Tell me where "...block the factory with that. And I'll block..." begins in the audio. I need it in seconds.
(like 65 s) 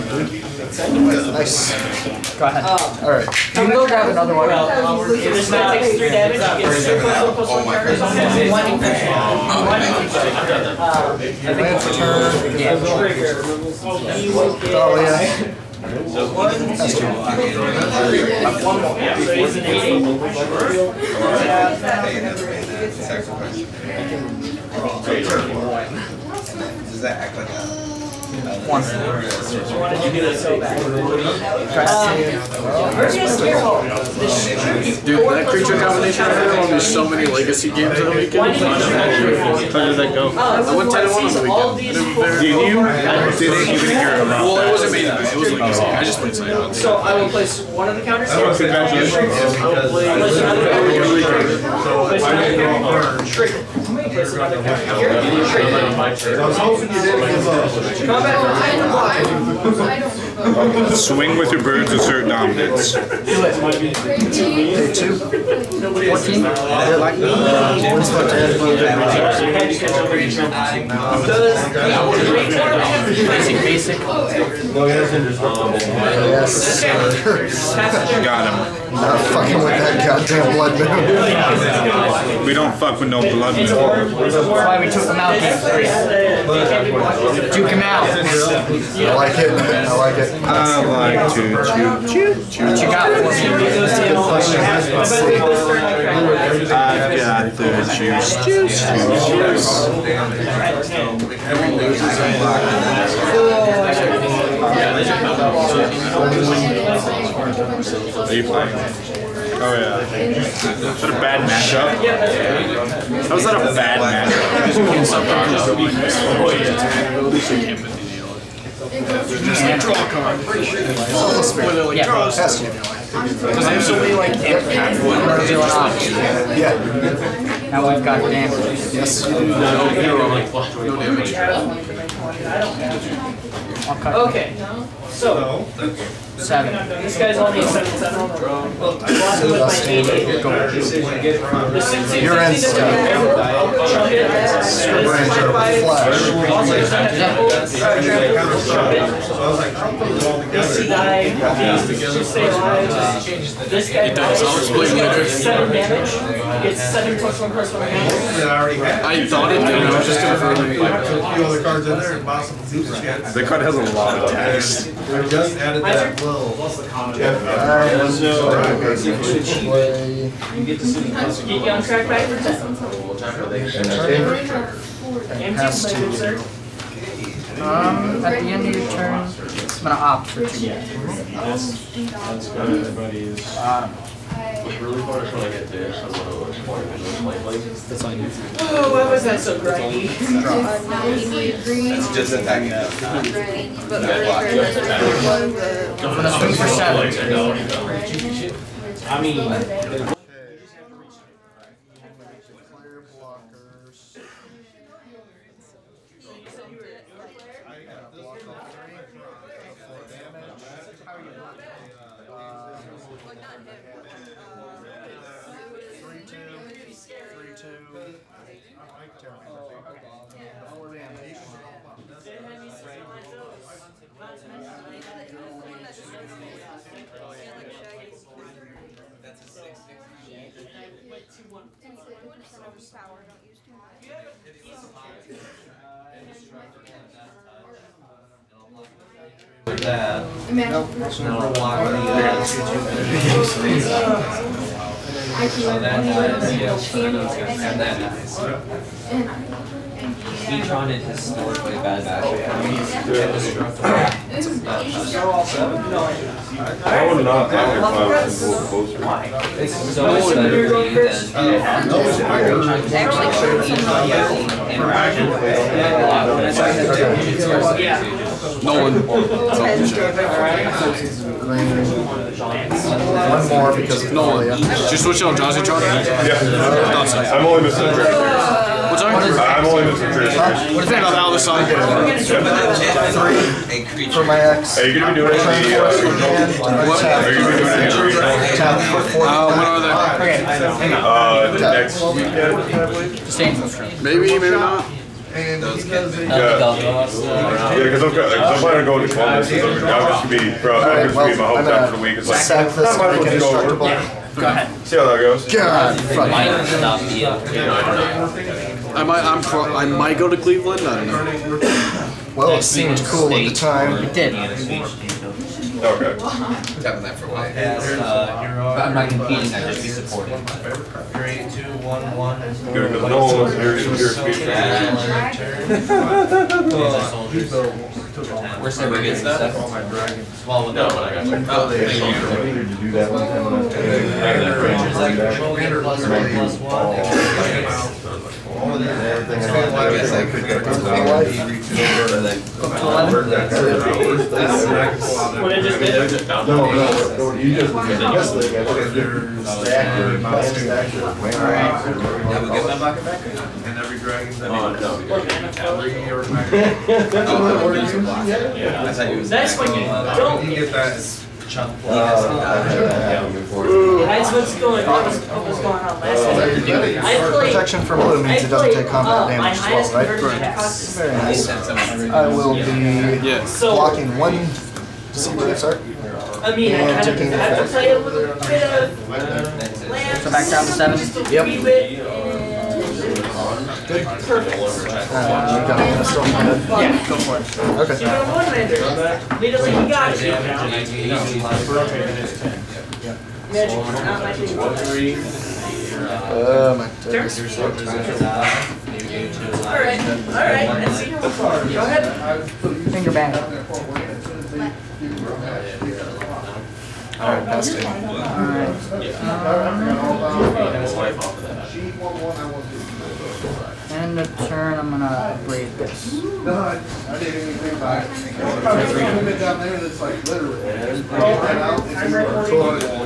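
238 s.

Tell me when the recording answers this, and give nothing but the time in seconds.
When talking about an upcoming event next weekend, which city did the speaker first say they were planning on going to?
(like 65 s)
299 s.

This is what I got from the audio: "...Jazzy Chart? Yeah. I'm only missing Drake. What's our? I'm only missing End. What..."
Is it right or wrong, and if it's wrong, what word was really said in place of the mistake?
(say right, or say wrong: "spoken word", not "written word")
wrong: "Drake", not "End".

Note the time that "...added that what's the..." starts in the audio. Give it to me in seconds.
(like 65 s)
165 s.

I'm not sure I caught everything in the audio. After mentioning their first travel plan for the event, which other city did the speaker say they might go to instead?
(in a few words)
Cleveland.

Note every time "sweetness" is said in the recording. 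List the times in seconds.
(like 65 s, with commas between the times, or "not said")
not said.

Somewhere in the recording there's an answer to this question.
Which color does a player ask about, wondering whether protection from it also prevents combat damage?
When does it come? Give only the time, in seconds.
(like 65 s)
367 s.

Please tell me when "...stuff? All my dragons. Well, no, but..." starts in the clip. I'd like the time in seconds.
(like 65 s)
329 s.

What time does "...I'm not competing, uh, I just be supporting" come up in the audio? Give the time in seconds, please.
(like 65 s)
318 s.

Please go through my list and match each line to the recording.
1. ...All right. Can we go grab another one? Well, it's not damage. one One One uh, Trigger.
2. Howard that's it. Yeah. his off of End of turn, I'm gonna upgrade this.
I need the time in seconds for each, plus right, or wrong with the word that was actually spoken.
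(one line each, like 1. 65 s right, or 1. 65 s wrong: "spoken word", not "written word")
1. 3 s right
2. 407 s right.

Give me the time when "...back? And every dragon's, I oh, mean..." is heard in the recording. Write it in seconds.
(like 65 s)
353 s.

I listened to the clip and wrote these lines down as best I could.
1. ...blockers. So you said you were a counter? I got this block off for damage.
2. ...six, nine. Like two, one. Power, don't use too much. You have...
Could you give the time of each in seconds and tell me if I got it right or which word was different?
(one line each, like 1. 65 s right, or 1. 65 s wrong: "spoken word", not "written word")
1. 203 s wrong: "player", not "counter"
2. 229 s right.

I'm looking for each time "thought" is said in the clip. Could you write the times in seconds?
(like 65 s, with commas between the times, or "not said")
159 s, 358 s.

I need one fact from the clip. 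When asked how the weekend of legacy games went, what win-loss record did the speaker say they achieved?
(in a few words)
10-1.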